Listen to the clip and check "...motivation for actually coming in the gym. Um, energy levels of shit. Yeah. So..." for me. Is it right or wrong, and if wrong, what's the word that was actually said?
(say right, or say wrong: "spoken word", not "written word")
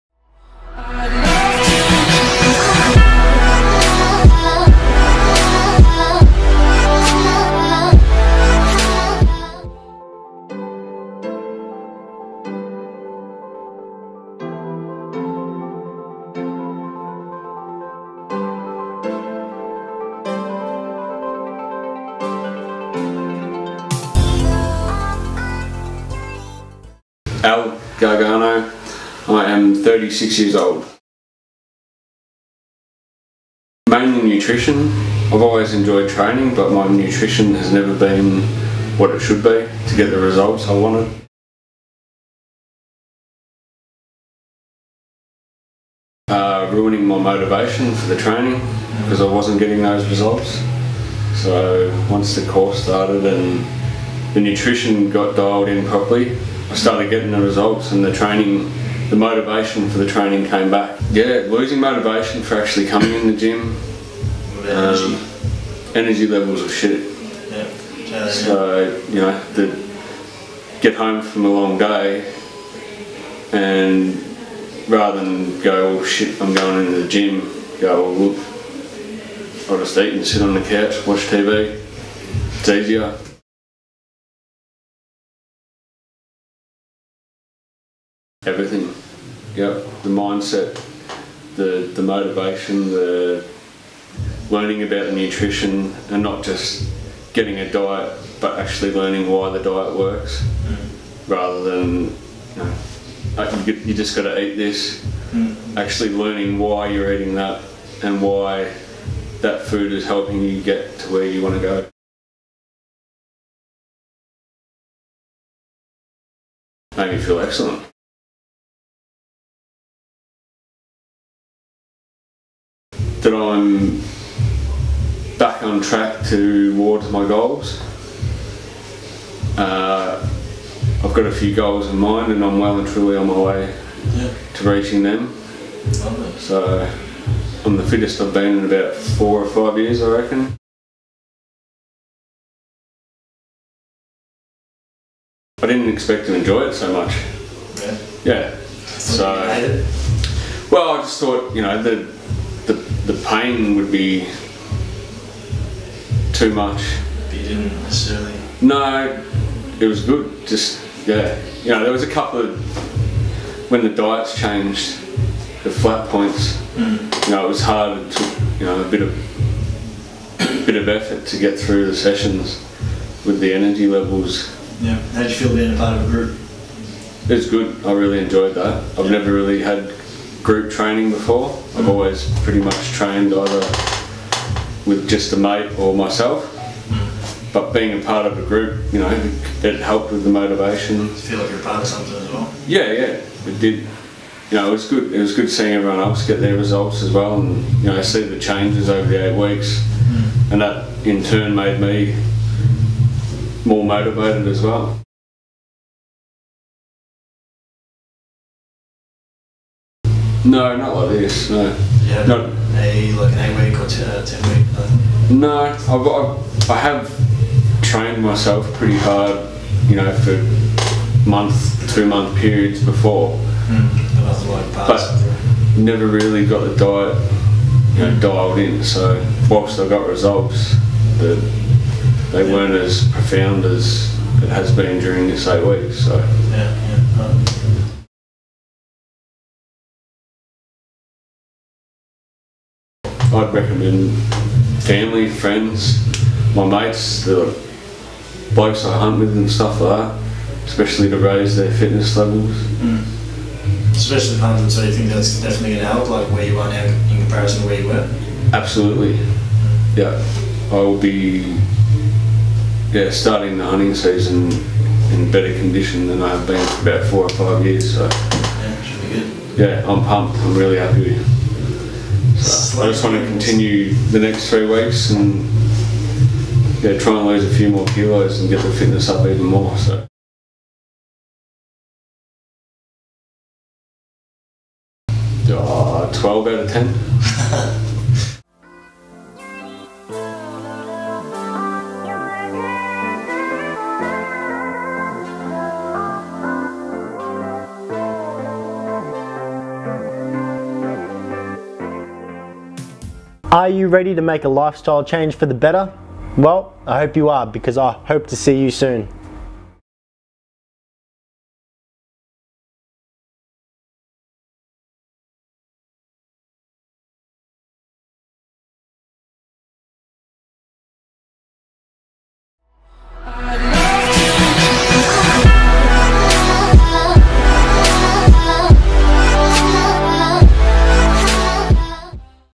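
right.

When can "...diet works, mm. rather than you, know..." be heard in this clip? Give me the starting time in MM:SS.
01:39.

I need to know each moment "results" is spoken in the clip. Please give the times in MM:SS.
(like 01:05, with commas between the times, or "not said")
00:40, 00:50, 00:57, 03:16, 03:50.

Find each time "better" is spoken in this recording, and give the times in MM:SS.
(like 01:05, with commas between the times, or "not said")
04:25, 05:05.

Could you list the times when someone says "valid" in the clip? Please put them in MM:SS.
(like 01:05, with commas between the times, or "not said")
not said.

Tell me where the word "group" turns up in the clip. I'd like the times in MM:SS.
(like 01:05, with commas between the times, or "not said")
02:56, 03:00, 03:08.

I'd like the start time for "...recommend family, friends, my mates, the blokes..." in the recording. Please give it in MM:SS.
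04:03.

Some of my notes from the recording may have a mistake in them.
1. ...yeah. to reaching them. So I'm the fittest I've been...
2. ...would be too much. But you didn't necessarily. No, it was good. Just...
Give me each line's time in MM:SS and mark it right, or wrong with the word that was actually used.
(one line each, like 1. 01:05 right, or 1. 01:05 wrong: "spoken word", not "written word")
1. 02:14 right
2. 02:33 right.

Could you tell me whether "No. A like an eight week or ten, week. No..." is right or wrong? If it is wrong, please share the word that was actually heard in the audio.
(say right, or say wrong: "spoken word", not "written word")
right.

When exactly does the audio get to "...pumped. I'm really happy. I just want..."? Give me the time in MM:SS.
04:30.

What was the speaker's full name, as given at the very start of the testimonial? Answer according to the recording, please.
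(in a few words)
Al Gargano.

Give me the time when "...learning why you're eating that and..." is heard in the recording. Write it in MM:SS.
01:46.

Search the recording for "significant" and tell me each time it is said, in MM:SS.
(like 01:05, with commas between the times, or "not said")
not said.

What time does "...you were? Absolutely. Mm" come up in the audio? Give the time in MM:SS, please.
04:17.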